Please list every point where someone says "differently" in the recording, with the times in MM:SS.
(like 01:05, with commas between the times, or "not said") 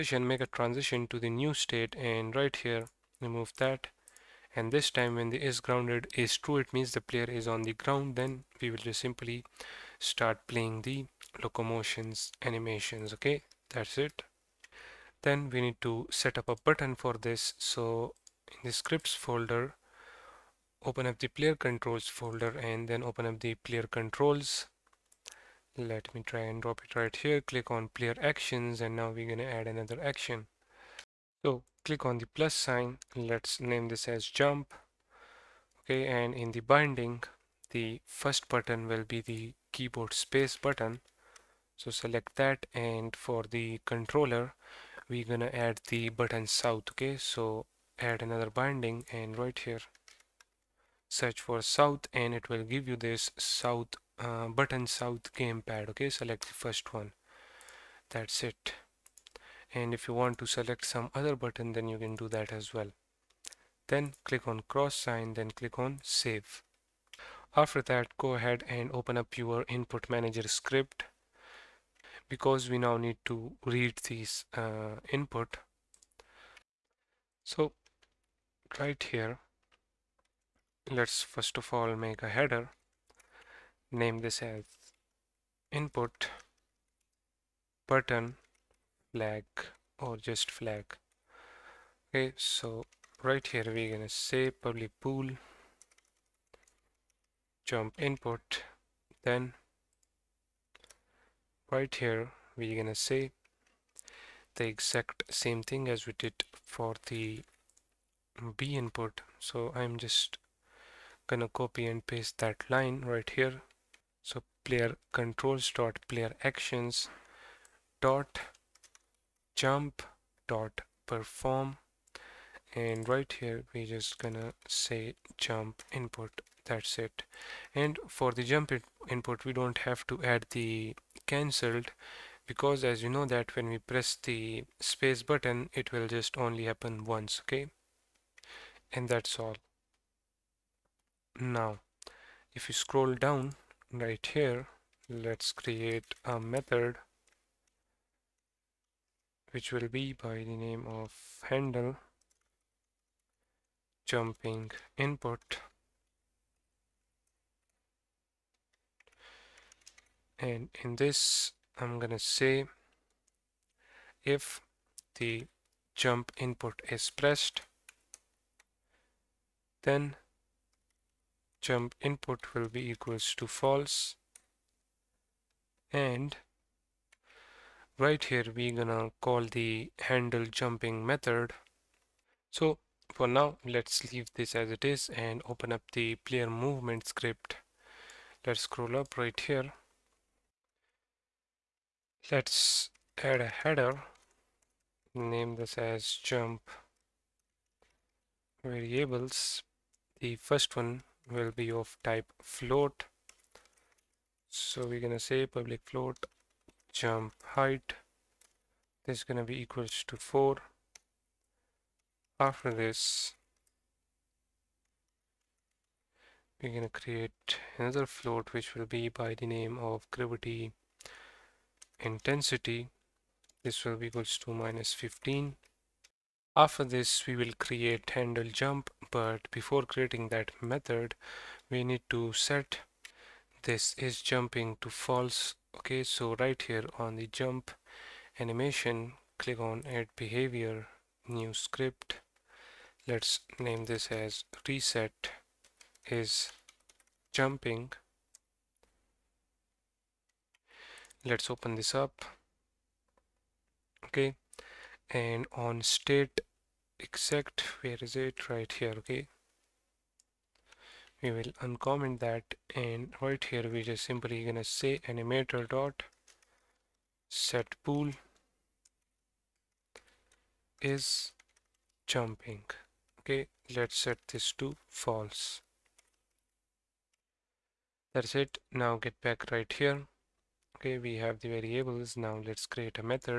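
not said.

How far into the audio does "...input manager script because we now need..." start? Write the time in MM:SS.
01:09.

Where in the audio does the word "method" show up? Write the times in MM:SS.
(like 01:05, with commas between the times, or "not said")
02:26, 03:01, 03:50.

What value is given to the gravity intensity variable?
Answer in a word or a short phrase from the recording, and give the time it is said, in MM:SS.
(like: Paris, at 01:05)
-15, at 03:44.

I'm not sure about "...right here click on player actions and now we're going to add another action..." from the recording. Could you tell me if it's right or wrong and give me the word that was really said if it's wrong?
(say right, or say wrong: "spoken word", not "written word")
right.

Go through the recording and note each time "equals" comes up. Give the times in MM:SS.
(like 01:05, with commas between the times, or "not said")
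02:52, 03:29, 03:44.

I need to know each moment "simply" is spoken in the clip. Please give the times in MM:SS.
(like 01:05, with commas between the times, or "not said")
00:09, 04:24.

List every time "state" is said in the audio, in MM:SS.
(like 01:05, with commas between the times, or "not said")
00:01, 04:15.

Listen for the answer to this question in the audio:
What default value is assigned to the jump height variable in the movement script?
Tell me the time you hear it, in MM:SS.
03:30.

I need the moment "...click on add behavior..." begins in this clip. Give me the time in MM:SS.
03:59.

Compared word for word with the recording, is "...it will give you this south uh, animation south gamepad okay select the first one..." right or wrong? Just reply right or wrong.
wrong.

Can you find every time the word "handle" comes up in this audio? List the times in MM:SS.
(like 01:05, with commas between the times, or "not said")
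02:31, 03:00, 03:48.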